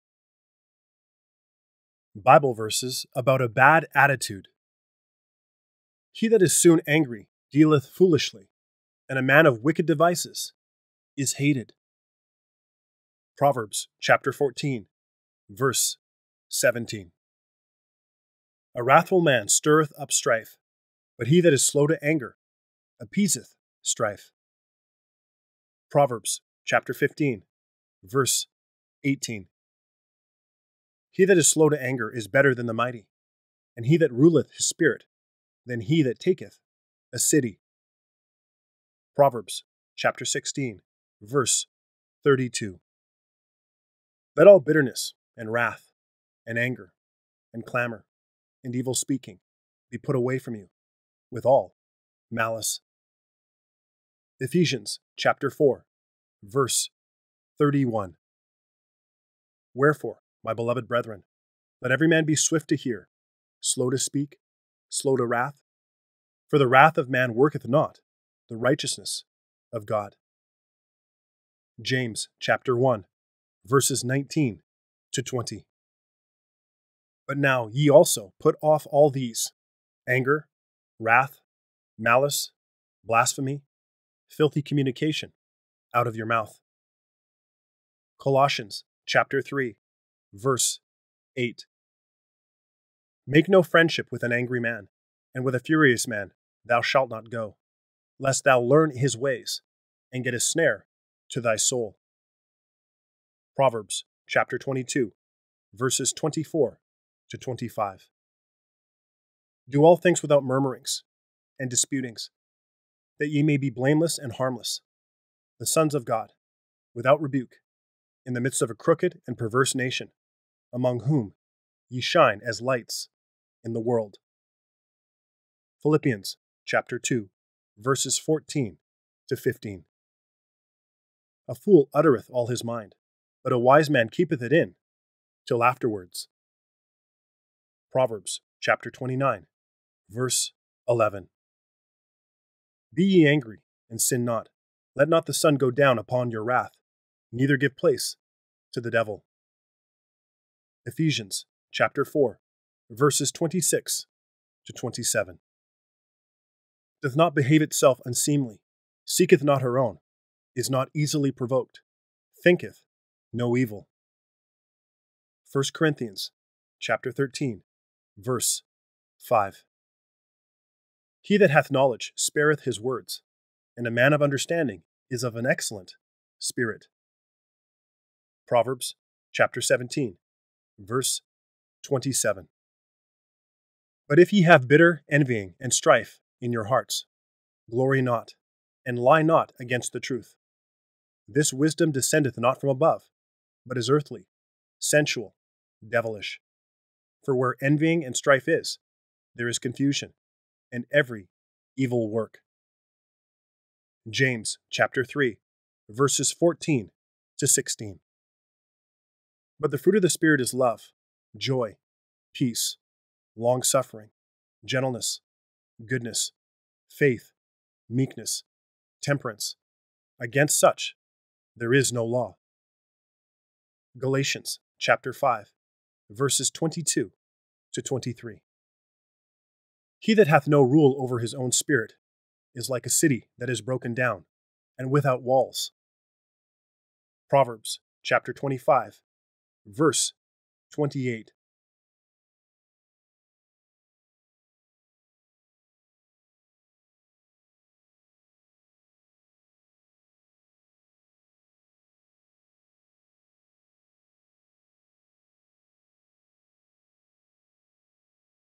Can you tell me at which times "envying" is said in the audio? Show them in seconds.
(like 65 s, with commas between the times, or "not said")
185 s, 197 s.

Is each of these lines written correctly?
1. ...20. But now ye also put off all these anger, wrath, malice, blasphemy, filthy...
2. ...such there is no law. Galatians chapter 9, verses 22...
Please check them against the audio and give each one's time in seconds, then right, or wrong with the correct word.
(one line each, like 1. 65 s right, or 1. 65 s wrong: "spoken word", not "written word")
1. 75 s right
2. 220 s wrong: "5", not "9".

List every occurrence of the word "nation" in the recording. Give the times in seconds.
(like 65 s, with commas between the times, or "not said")
119 s.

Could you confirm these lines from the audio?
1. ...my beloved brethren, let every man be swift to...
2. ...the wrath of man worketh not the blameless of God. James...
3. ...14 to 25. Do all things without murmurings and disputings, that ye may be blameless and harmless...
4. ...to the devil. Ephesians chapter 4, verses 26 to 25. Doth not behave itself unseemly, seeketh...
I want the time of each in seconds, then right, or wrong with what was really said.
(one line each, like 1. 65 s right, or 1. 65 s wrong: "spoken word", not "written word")
1. 60 s right
2. 66 s wrong: "righteousness", not "blameless"
3. 106 s wrong: "24", not "14"
4. 148 s wrong: "27", not "25".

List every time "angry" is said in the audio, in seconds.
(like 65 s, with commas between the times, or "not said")
6 s, 94 s, 143 s.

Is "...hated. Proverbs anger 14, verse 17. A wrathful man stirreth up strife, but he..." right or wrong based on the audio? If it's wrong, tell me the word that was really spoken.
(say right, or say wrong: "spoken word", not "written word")
wrong: "chapter", not "anger".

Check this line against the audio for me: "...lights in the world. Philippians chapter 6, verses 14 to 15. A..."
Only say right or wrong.
wrong.